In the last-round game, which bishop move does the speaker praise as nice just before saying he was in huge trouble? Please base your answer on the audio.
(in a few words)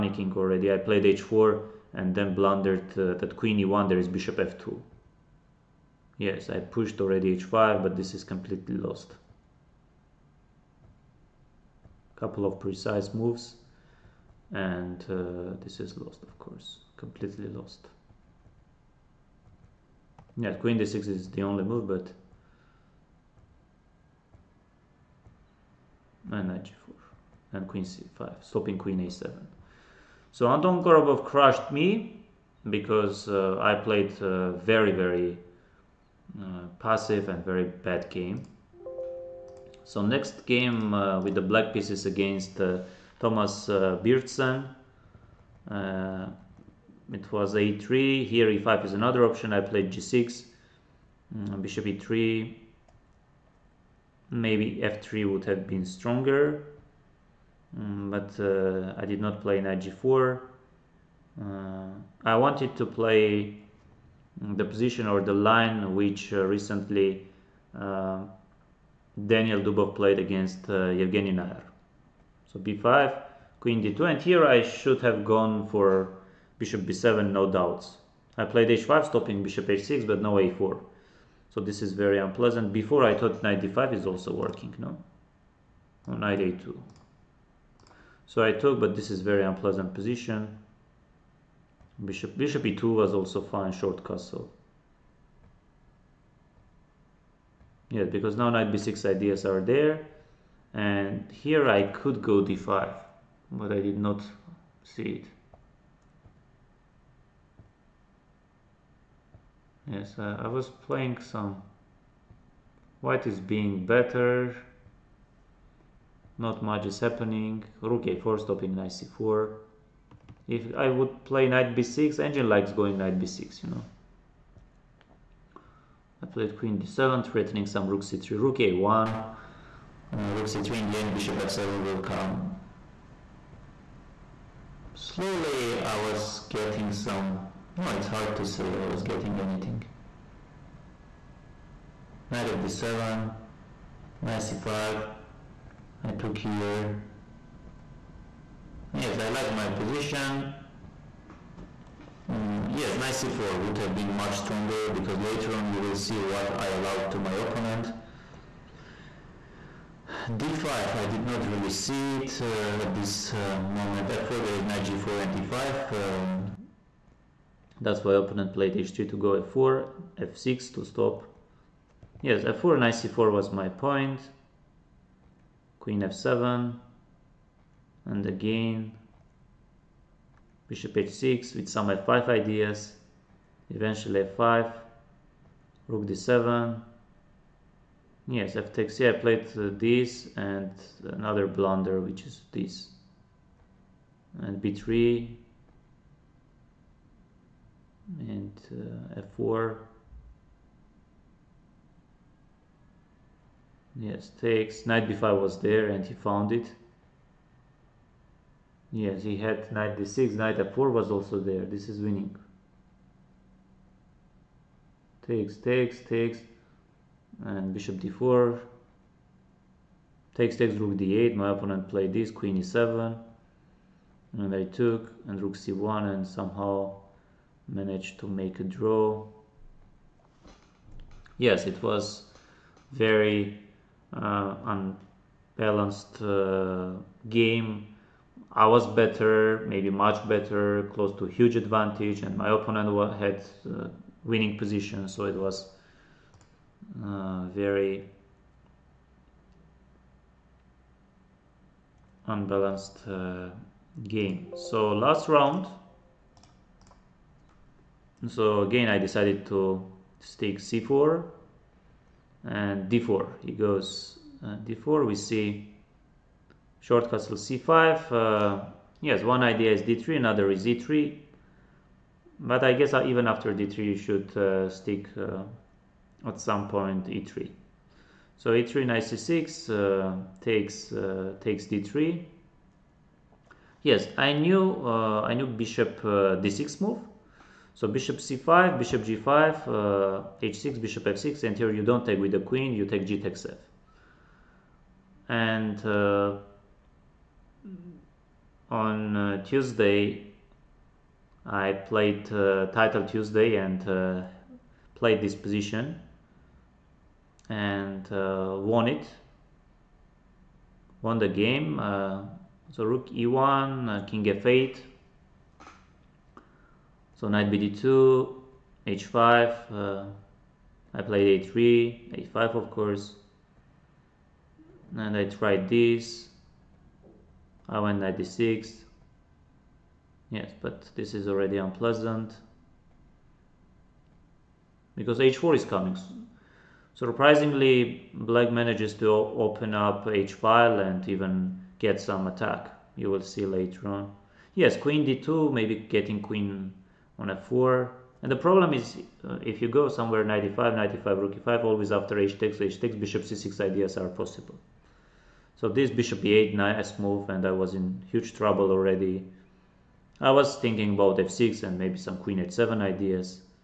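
bishop e8.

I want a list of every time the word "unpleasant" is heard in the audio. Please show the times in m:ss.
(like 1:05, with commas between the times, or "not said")
1:22, 1:29, 5:31.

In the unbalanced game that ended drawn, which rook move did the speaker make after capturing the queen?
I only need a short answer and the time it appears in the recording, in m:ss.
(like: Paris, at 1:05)
rook c1, at 3:45.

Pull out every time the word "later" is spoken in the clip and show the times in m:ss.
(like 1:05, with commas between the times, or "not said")
2:35, 5:43.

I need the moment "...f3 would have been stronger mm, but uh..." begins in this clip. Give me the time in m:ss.
0:54.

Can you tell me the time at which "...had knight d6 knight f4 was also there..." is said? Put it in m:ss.
3:29.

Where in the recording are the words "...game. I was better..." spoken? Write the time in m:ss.
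3:57.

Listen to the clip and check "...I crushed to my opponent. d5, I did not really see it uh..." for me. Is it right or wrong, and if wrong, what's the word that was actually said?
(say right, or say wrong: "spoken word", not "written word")
wrong: "allowed", not "crushed".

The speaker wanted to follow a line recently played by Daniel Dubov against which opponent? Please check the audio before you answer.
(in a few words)
Evgeny Najer.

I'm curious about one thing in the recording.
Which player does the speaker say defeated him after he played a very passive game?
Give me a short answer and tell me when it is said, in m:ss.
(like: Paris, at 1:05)
Anton Korobov, at 0:30.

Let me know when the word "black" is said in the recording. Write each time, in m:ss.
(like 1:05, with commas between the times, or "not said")
0:41, 5:38.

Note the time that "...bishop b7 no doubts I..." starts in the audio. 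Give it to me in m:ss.
1:16.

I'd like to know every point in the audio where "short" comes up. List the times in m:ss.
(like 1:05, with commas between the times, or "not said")
1:33, 4:26.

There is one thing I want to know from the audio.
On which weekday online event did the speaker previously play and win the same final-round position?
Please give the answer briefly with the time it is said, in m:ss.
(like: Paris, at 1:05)
Title Tuesday, at 5:02.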